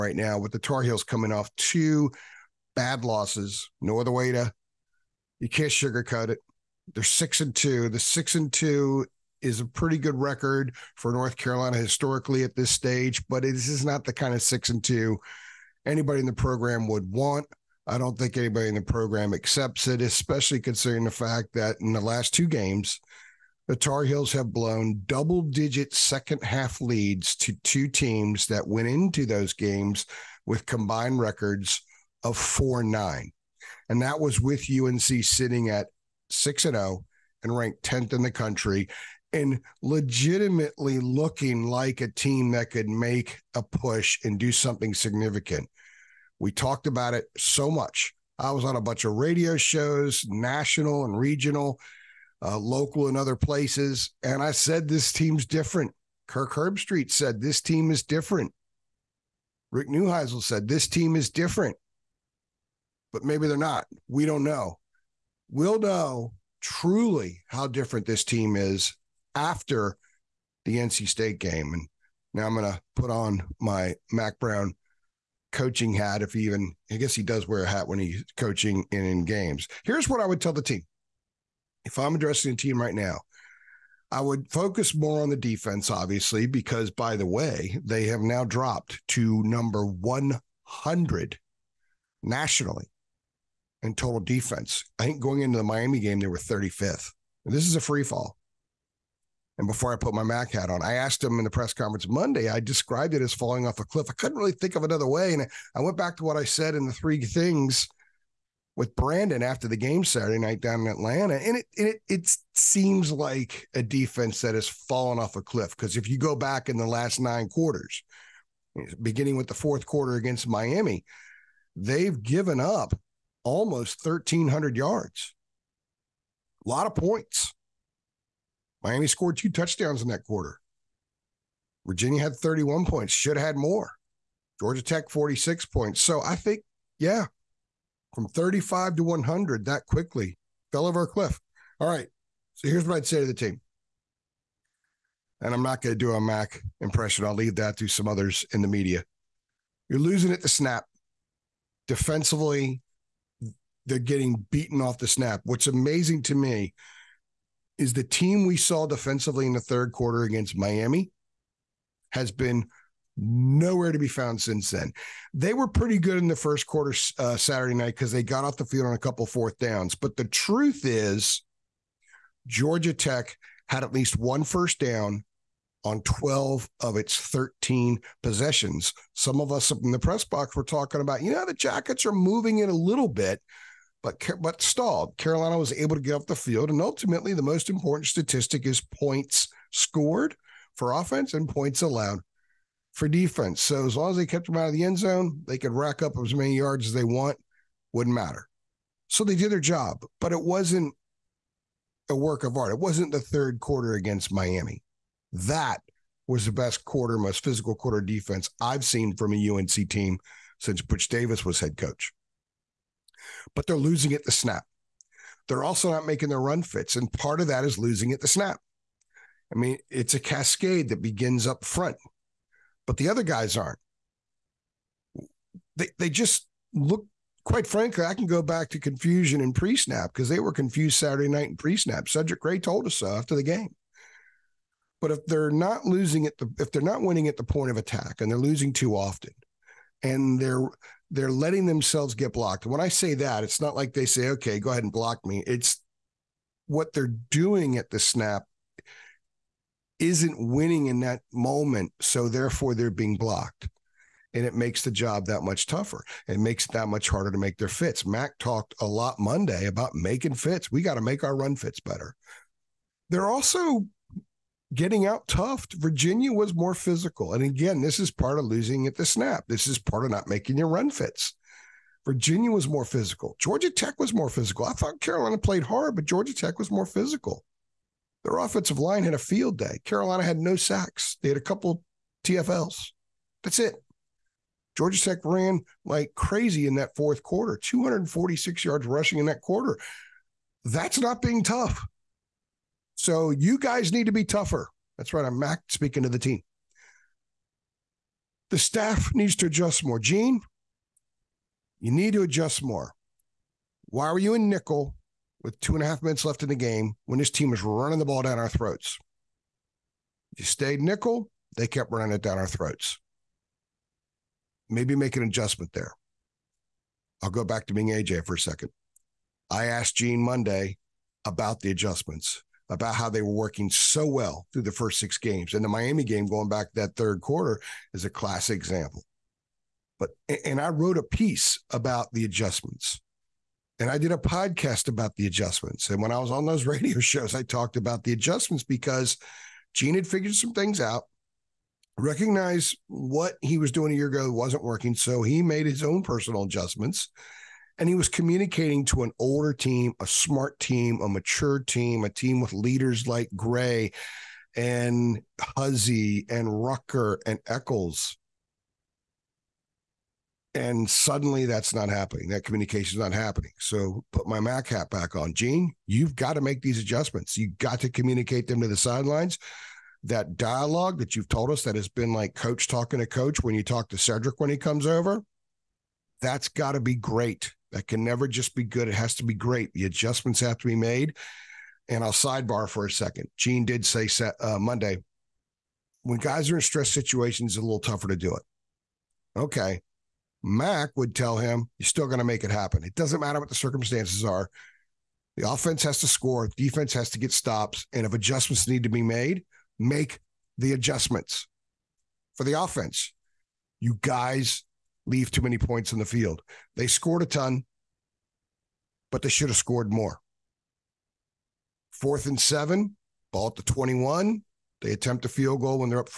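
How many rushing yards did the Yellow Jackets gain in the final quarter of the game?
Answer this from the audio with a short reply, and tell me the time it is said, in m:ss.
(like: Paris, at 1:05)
246, at 4:47.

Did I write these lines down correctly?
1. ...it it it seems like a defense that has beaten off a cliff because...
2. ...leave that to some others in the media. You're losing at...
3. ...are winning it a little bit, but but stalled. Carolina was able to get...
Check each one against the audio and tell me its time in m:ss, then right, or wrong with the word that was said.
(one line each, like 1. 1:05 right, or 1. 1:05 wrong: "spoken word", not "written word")
1. 1:51 wrong: "fallen", not "beaten"
2. 2:27 right
3. 3:02 wrong: "moving", not "winning".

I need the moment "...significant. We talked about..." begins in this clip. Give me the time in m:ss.
0:44.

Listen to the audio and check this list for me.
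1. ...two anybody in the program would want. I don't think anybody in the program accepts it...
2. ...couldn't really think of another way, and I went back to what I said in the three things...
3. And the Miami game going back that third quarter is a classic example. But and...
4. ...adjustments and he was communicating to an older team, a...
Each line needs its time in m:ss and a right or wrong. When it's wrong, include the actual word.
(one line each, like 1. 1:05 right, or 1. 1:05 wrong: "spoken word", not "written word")
1. 0:14 right
2. 1:44 right
3. 5:25 right
4. 5:46 right.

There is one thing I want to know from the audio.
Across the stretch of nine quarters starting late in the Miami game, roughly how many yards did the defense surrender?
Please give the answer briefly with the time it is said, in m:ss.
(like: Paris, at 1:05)
1300, at 2:03.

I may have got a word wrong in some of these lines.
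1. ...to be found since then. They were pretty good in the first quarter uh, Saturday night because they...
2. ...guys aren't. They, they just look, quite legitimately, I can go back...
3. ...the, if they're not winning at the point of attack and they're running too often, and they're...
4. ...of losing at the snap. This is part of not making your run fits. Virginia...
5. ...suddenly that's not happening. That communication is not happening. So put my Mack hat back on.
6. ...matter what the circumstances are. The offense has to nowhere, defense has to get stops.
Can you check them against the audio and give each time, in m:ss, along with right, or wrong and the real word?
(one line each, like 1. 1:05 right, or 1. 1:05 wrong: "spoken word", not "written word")
1. 2:43 right
2. 3:43 wrong: "frankly", not "legitimately"
3. 3:56 wrong: "losing", not "running"
4. 4:28 right
5. 6:00 right
6. 6:33 wrong: "score", not "nowhere".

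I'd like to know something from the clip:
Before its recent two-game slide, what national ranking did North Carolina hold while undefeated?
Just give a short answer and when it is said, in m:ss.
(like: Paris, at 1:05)
10th, at 0:37.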